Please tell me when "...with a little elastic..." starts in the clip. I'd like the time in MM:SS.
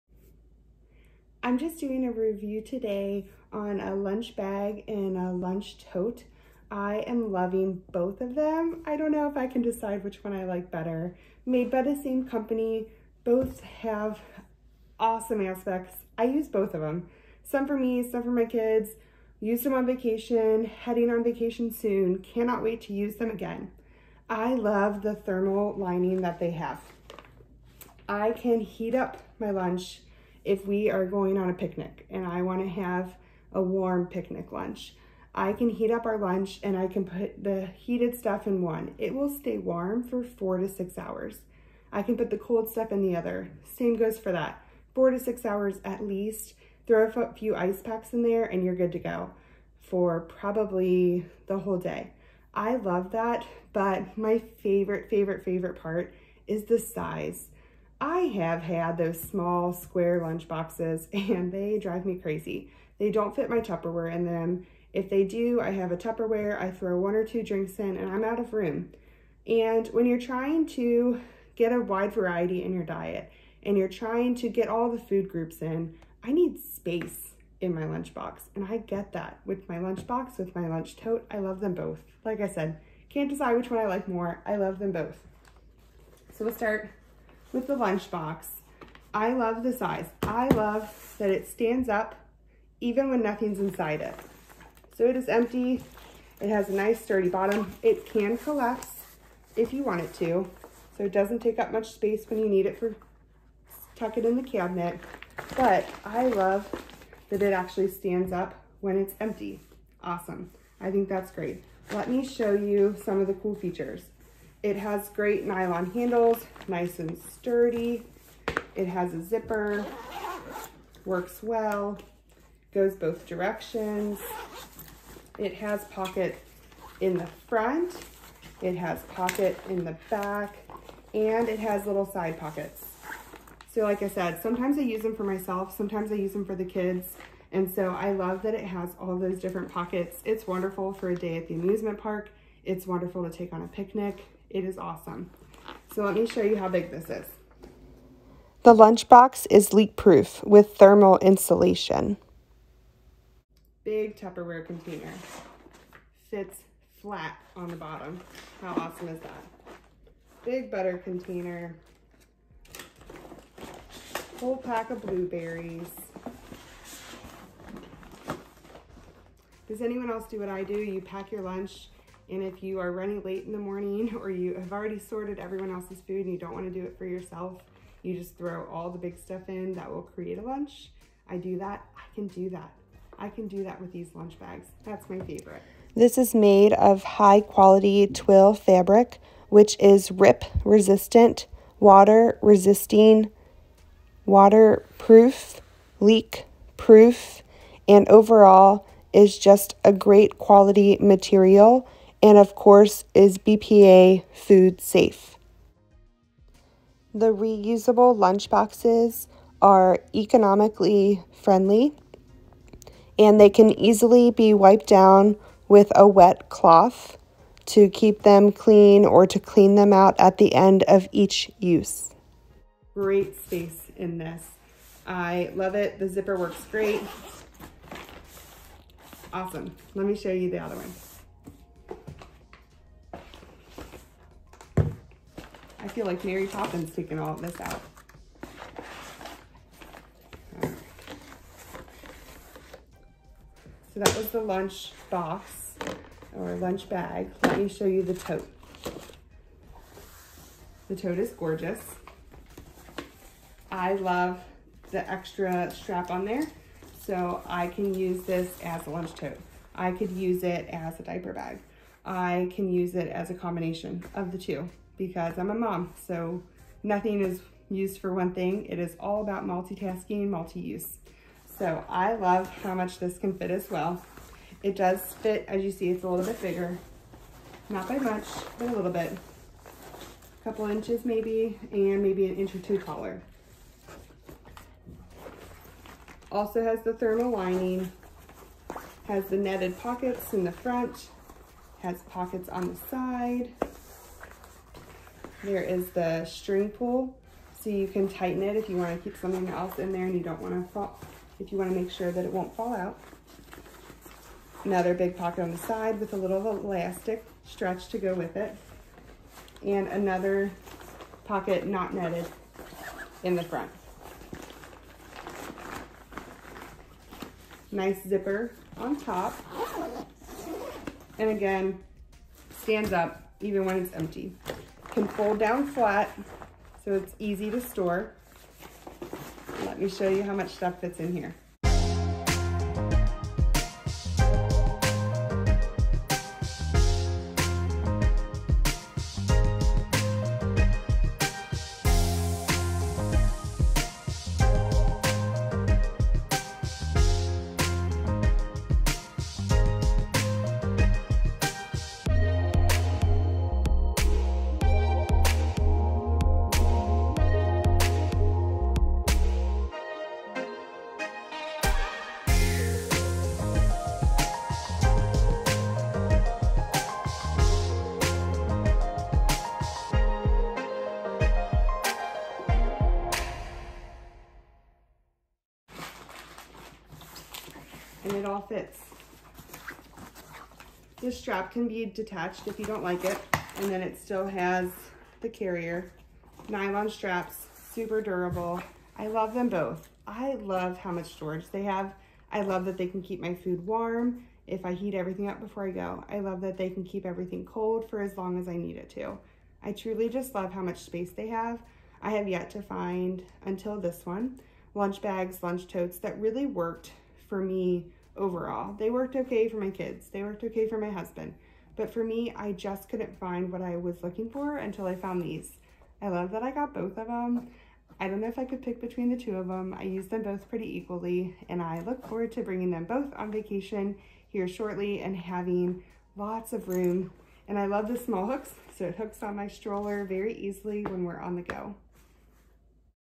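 05:05.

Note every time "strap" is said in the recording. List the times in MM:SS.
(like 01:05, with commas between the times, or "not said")
04:15, 06:21, 06:26.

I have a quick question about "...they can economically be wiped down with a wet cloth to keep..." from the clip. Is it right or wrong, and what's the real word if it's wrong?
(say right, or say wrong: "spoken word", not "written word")
wrong: "easily", not "economically".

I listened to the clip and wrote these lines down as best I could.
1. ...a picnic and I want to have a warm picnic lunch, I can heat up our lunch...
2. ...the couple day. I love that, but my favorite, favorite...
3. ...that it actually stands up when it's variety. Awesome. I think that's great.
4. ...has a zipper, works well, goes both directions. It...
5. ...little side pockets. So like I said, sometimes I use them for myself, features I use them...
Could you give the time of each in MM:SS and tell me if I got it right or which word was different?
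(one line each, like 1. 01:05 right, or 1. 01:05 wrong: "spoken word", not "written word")
1. 00:31 right
2. 00:51 wrong: "whole", not "couple"
3. 01:47 wrong: "empty", not "variety"
4. 01:58 right
5. 02:11 wrong: "sometimes", not "features".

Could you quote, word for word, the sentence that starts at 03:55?
feel like Mary Poppins taking all this out.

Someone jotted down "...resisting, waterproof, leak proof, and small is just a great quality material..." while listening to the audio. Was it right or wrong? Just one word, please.
wrong.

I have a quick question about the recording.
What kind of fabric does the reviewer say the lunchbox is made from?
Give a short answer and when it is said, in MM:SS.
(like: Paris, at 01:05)
twill, at 03:08.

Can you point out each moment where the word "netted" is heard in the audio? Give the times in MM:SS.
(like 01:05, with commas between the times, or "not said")
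04:49, 05:11.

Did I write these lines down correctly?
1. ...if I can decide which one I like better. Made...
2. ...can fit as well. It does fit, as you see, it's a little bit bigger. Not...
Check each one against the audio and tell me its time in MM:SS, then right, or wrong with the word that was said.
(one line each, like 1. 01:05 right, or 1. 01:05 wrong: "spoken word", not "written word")
1. 00:09 right
2. 04:33 right.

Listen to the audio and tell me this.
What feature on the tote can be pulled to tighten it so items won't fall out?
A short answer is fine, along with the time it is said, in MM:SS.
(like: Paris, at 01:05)
string pull, at 04:56.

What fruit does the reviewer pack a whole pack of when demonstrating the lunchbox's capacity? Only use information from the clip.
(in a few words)
blueberries.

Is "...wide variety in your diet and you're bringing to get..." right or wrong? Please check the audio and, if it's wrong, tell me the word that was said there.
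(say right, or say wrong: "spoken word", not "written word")
wrong: "trying", not "bringing".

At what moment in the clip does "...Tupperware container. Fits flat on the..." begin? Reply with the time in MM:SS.
02:34.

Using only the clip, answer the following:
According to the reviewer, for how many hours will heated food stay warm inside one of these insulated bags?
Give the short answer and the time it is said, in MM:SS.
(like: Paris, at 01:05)
4 to 6 hours, at 00:40.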